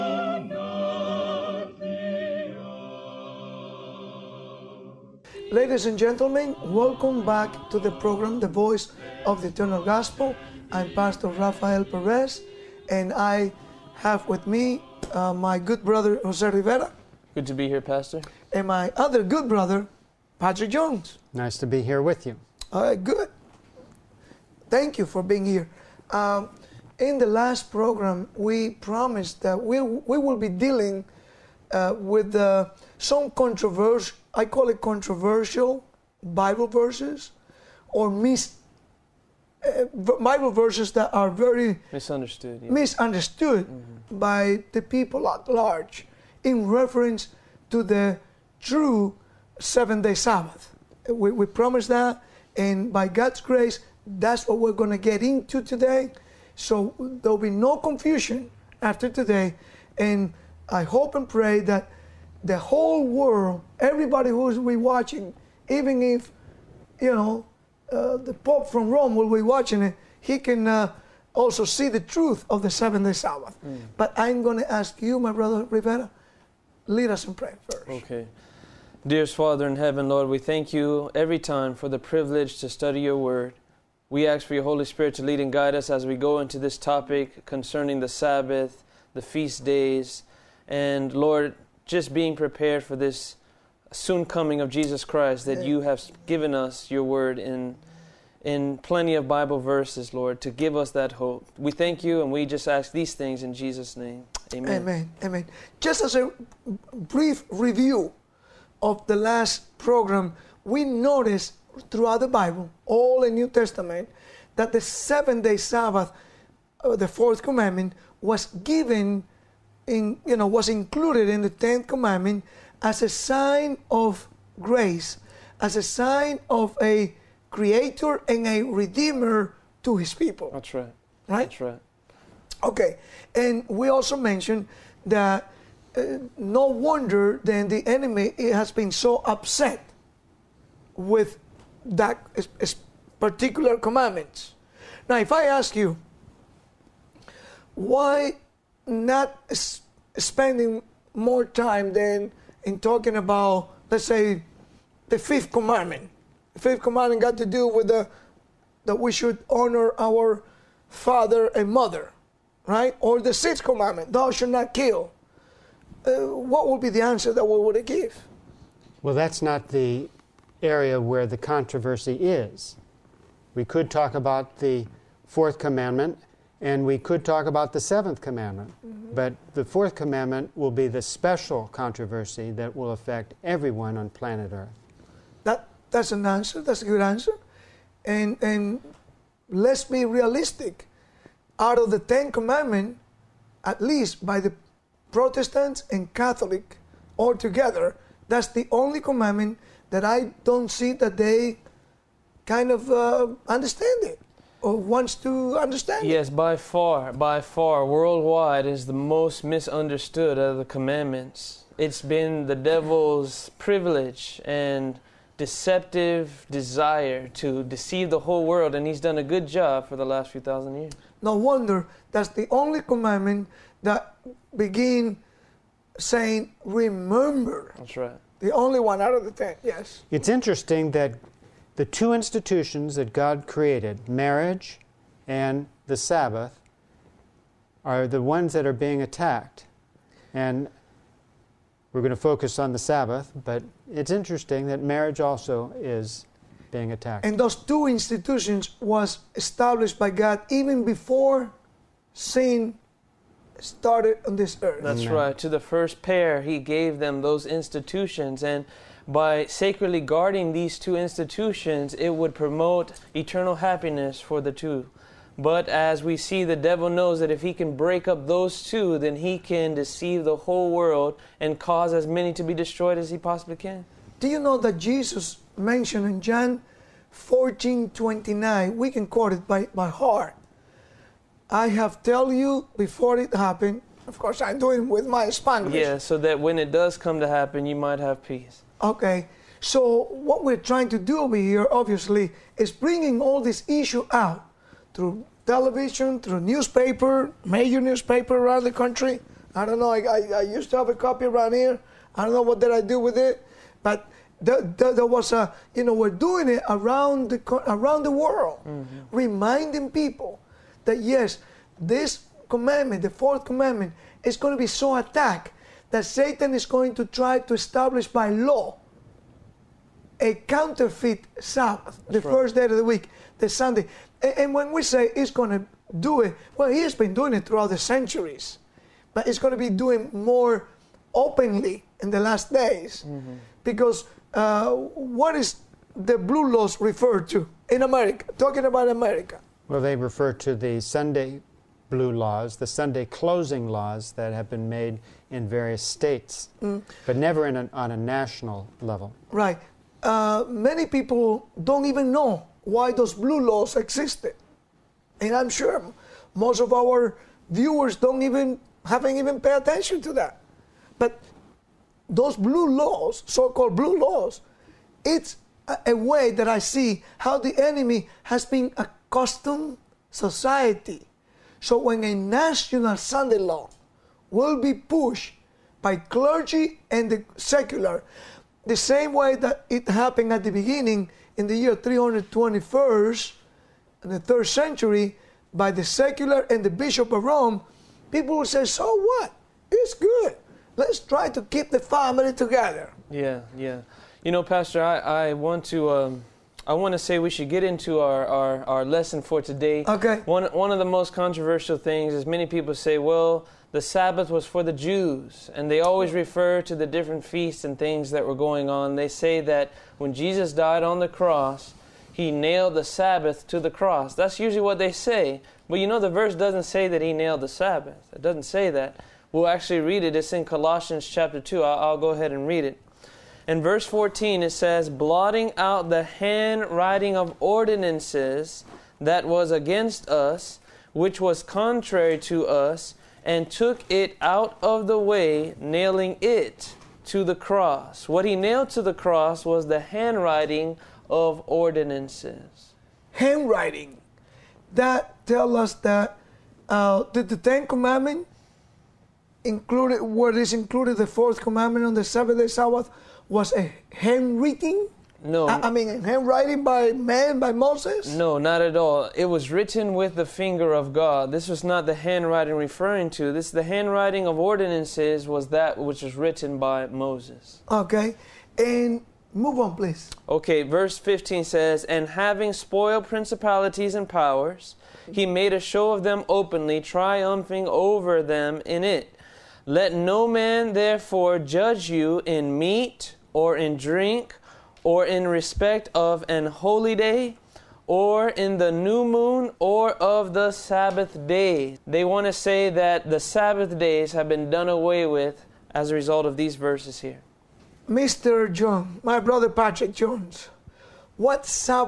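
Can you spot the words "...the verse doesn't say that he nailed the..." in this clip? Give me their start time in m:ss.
6:55.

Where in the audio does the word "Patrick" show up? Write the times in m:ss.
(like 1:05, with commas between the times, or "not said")
0:20, 8:19.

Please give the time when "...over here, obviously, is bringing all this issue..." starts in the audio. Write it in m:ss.
4:51.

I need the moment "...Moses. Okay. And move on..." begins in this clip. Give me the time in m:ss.
7:46.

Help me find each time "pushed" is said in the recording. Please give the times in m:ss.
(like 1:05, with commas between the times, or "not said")
6:14.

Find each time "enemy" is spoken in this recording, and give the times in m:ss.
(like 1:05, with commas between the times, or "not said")
2:17, 6:07.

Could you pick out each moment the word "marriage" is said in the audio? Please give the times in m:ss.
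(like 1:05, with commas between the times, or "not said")
3:54, 4:04.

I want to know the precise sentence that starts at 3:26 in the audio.
Yes, by far, by far, worldwide is the most misunderstood of the commandments.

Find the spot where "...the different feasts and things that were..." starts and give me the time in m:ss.
6:46.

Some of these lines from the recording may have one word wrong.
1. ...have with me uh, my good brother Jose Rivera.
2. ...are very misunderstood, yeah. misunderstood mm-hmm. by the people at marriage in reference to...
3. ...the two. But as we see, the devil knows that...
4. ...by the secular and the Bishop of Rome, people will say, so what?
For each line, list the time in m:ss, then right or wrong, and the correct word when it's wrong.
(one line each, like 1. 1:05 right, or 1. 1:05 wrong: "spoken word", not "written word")
1. 0:13 right
2. 0:41 wrong: "large", not "marriage"
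3. 4:24 right
4. 6:25 right.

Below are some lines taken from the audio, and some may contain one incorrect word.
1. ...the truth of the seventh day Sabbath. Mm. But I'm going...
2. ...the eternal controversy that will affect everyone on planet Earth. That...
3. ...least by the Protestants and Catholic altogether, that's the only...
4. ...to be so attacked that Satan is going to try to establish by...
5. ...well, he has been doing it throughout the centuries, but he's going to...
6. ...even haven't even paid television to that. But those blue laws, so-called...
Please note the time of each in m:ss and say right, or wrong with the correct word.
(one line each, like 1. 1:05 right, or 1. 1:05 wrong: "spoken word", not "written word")
1. 1:11 right
2. 3:00 wrong: "special", not "eternal"
3. 3:13 right
4. 5:14 right
5. 5:26 right
6. 5:58 wrong: "attention", not "television".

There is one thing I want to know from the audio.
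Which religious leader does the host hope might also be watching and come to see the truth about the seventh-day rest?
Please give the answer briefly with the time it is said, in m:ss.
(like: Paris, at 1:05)
the Pope, at 1:08.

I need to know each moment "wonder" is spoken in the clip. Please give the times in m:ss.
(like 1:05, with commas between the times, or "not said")
2:16, 3:41.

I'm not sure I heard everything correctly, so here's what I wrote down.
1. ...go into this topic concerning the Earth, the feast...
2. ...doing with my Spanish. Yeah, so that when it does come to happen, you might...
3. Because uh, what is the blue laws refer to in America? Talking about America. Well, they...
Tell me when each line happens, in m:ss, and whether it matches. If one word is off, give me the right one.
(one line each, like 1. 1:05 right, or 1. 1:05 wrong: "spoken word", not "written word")
1. 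1:26 wrong: "Sabbath", not "Earth"
2. 4:44 right
3. 5:33 right.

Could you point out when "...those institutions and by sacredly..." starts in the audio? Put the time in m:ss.
4:17.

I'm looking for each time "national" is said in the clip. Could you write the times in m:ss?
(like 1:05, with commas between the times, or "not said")
5:47, 6:12.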